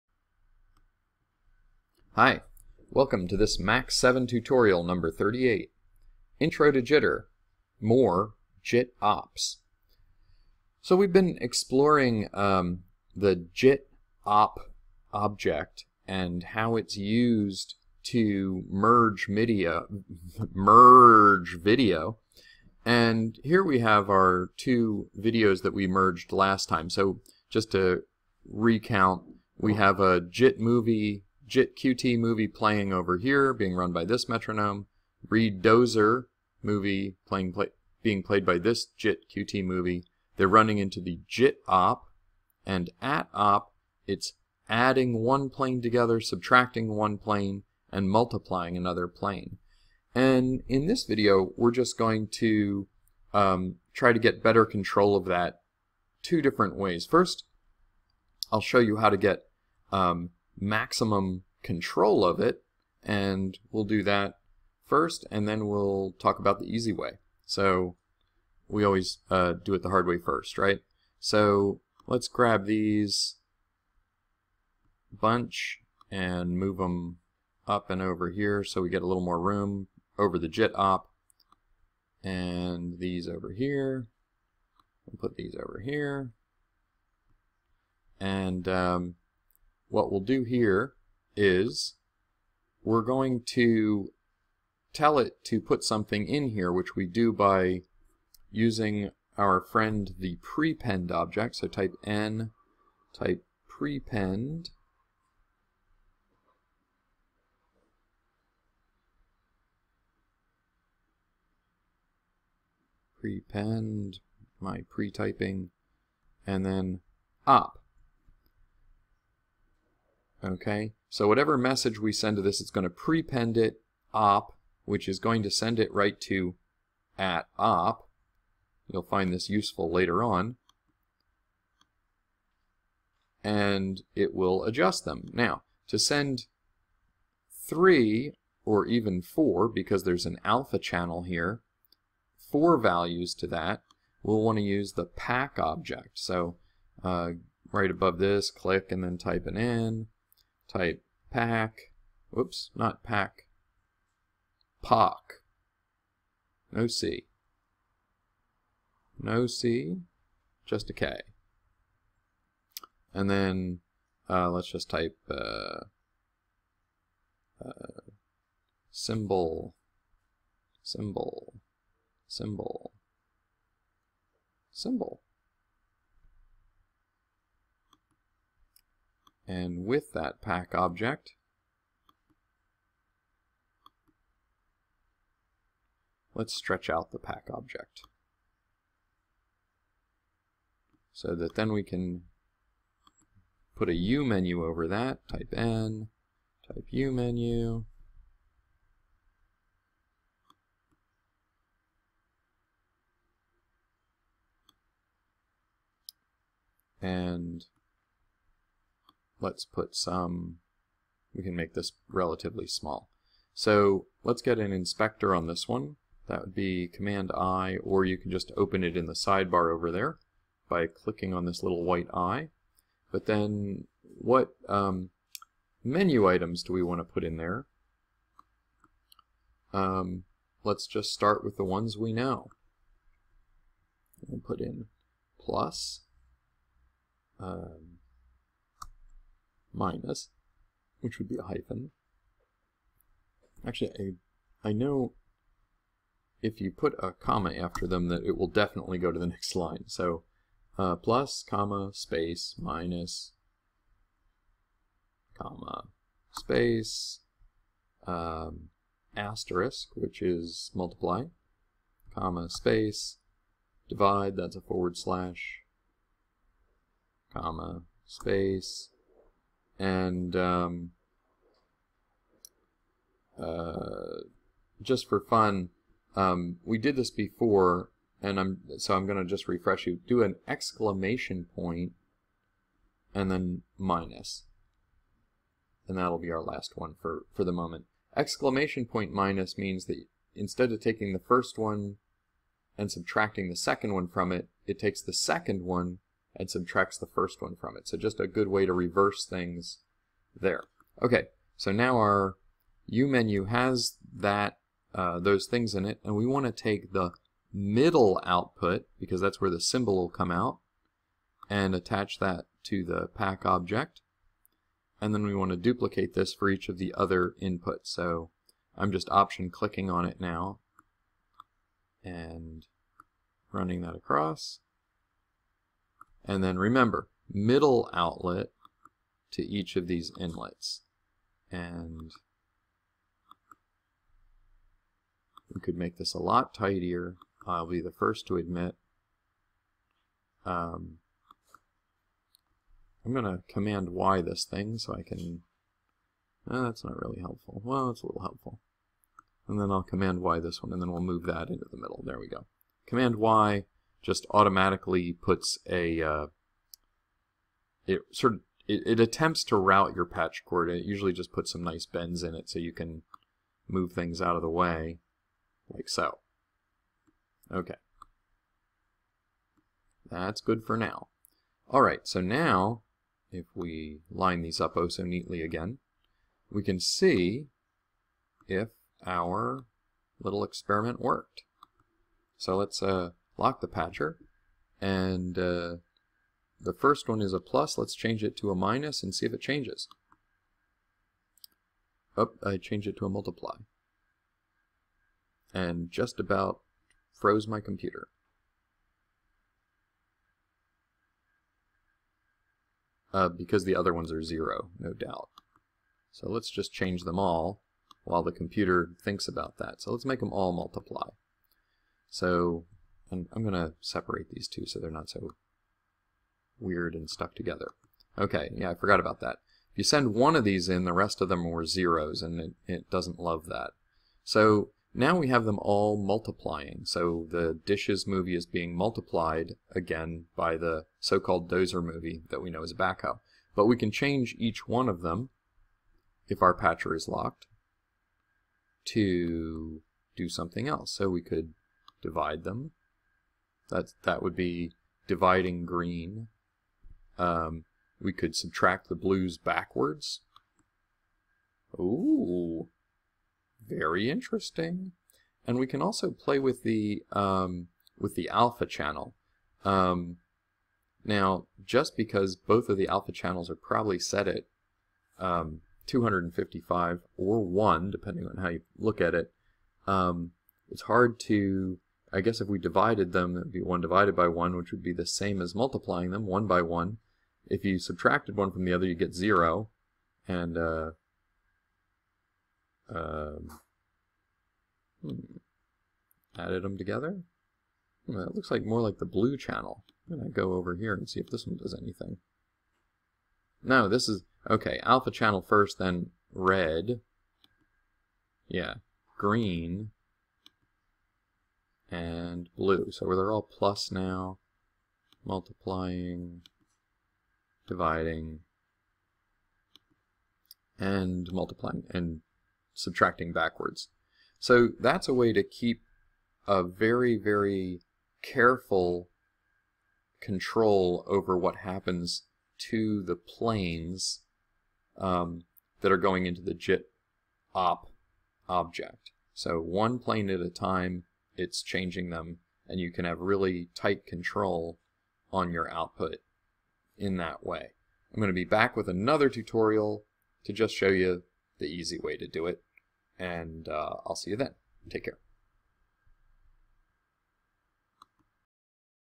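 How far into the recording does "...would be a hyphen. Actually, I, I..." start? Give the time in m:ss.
4:01.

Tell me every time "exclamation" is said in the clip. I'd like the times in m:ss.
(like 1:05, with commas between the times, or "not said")
4:40, 4:48.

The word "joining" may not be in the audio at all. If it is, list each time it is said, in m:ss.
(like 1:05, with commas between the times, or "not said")
not said.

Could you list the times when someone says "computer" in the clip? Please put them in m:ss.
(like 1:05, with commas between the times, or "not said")
6:37, 6:48.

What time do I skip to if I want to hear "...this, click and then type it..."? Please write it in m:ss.
2:28.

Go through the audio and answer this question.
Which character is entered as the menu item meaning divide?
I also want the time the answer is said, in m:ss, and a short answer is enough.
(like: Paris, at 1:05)
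forward slash, at 4:24.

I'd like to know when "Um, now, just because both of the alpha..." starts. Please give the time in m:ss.
7:39.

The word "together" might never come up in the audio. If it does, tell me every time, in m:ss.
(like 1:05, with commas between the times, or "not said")
0:45, 6:57, 8:06.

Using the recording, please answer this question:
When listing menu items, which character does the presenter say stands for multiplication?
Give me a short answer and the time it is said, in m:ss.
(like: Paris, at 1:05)
asterisk, at 4:19.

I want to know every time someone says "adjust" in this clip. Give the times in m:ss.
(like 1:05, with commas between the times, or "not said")
2:14.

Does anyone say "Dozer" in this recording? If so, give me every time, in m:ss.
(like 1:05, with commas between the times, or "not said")
0:35, 7:11.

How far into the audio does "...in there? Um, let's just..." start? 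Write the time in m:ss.
3:47.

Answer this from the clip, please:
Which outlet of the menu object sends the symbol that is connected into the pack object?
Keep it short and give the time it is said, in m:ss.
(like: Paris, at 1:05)
middle output, at 5:07.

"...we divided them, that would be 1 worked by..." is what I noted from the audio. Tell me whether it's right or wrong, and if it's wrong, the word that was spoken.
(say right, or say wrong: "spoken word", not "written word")
wrong: "divided", not "worked".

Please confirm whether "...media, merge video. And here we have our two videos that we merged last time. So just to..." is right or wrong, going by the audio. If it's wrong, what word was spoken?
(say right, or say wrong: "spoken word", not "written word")
right.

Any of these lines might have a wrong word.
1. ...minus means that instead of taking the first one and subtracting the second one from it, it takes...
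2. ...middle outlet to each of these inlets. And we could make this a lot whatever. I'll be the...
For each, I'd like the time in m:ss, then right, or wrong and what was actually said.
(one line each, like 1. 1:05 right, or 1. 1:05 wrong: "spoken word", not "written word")
1. 4:49 right
2. 5:27 wrong: "tidier", not "whatever".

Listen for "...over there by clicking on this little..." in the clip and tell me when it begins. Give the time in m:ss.
3:39.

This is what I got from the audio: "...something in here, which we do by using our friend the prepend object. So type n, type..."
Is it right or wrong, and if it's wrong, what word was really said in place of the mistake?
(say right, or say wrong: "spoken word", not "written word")
right.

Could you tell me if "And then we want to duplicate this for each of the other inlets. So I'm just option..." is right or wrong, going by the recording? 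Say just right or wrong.
wrong.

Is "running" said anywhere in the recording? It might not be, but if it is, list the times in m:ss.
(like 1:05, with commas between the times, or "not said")
0:40, 5:23.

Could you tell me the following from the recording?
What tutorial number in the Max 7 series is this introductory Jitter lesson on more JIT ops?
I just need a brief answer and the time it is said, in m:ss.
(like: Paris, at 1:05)
38, at 0:05.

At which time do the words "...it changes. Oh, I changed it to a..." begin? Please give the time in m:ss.
6:29.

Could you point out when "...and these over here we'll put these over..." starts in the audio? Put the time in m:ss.
1:22.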